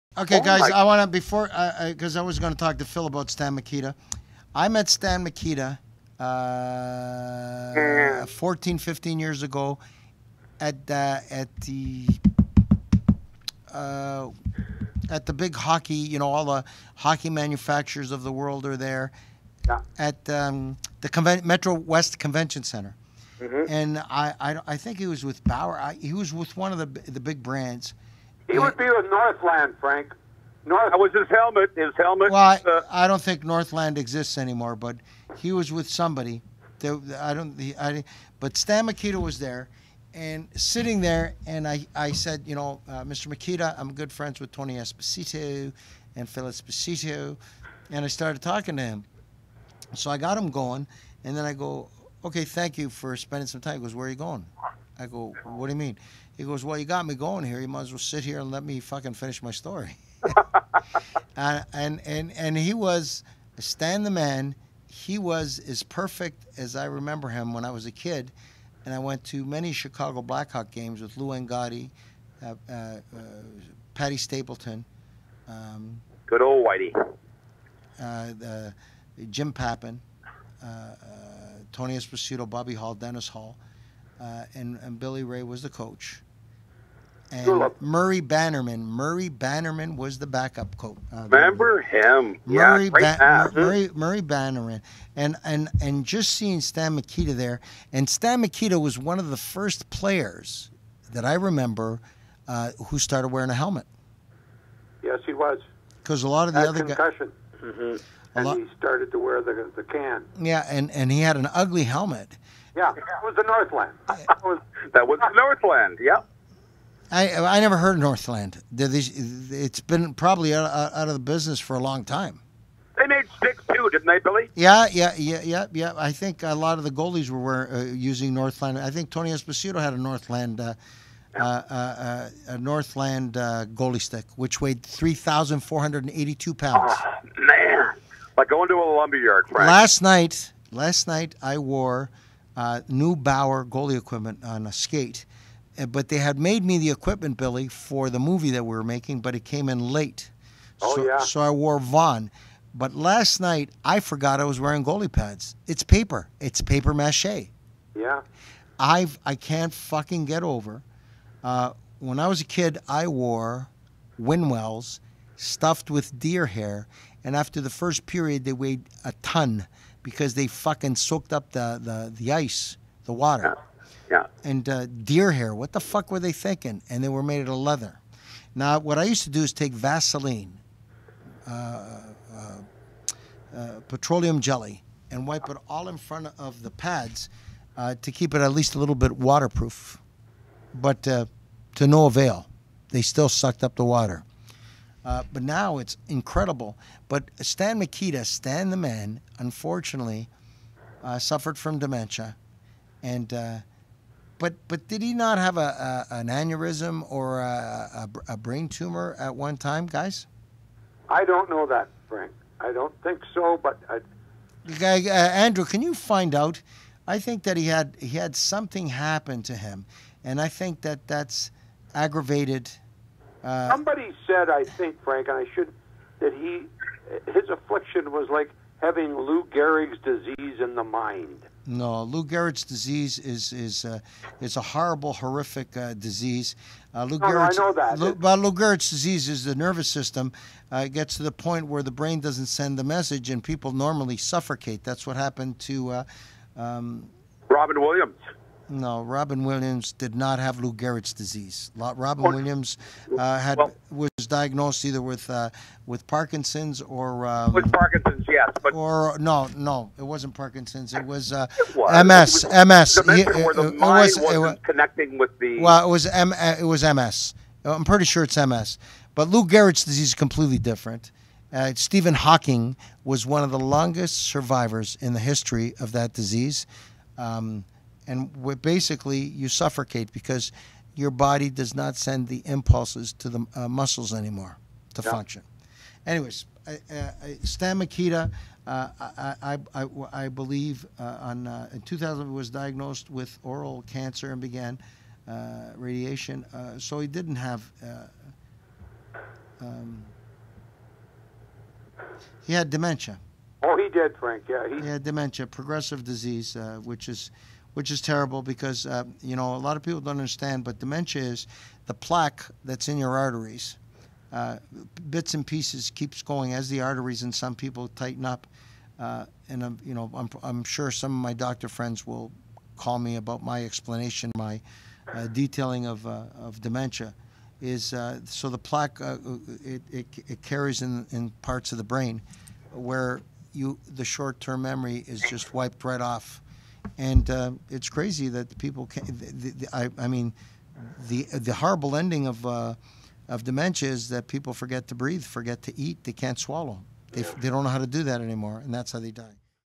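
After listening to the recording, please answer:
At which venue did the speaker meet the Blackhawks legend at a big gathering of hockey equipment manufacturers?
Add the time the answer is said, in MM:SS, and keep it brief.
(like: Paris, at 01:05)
Metro West Convention Center, at 00:21.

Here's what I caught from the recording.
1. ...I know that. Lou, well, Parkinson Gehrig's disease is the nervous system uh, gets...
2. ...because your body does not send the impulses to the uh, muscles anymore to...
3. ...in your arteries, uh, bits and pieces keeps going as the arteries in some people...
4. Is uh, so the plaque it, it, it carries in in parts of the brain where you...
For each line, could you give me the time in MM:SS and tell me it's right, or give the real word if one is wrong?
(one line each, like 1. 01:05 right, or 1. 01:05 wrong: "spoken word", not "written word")
1. 03:57 wrong: "Lou", not "Parkinson"
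2. 04:40 right
3. 05:12 right
4. 05:27 right.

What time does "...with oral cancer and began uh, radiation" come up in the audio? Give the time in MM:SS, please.
04:53.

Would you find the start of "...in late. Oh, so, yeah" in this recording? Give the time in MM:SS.
02:29.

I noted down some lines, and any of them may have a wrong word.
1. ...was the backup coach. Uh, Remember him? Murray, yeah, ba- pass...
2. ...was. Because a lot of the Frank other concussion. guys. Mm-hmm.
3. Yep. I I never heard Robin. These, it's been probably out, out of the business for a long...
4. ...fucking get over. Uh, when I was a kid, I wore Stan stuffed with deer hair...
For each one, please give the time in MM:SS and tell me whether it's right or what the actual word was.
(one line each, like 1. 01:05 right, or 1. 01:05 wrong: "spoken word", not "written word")
1. 01:29 right
2. 01:45 wrong: "Had", not "Frank"
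3. 01:56 wrong: "Northland", not "Robin"
4. 02:39 wrong: "Winnwells", not "Stan".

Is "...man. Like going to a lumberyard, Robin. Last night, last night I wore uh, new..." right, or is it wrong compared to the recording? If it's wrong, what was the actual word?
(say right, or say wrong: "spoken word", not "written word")
wrong: "Frank", not "Robin".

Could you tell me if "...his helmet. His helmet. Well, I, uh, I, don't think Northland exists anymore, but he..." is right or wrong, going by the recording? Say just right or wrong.
right.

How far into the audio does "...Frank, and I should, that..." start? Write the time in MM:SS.
03:45.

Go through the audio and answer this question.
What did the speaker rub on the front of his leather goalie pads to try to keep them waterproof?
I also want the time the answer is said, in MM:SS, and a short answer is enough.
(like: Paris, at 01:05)
Vaseline, at 02:59.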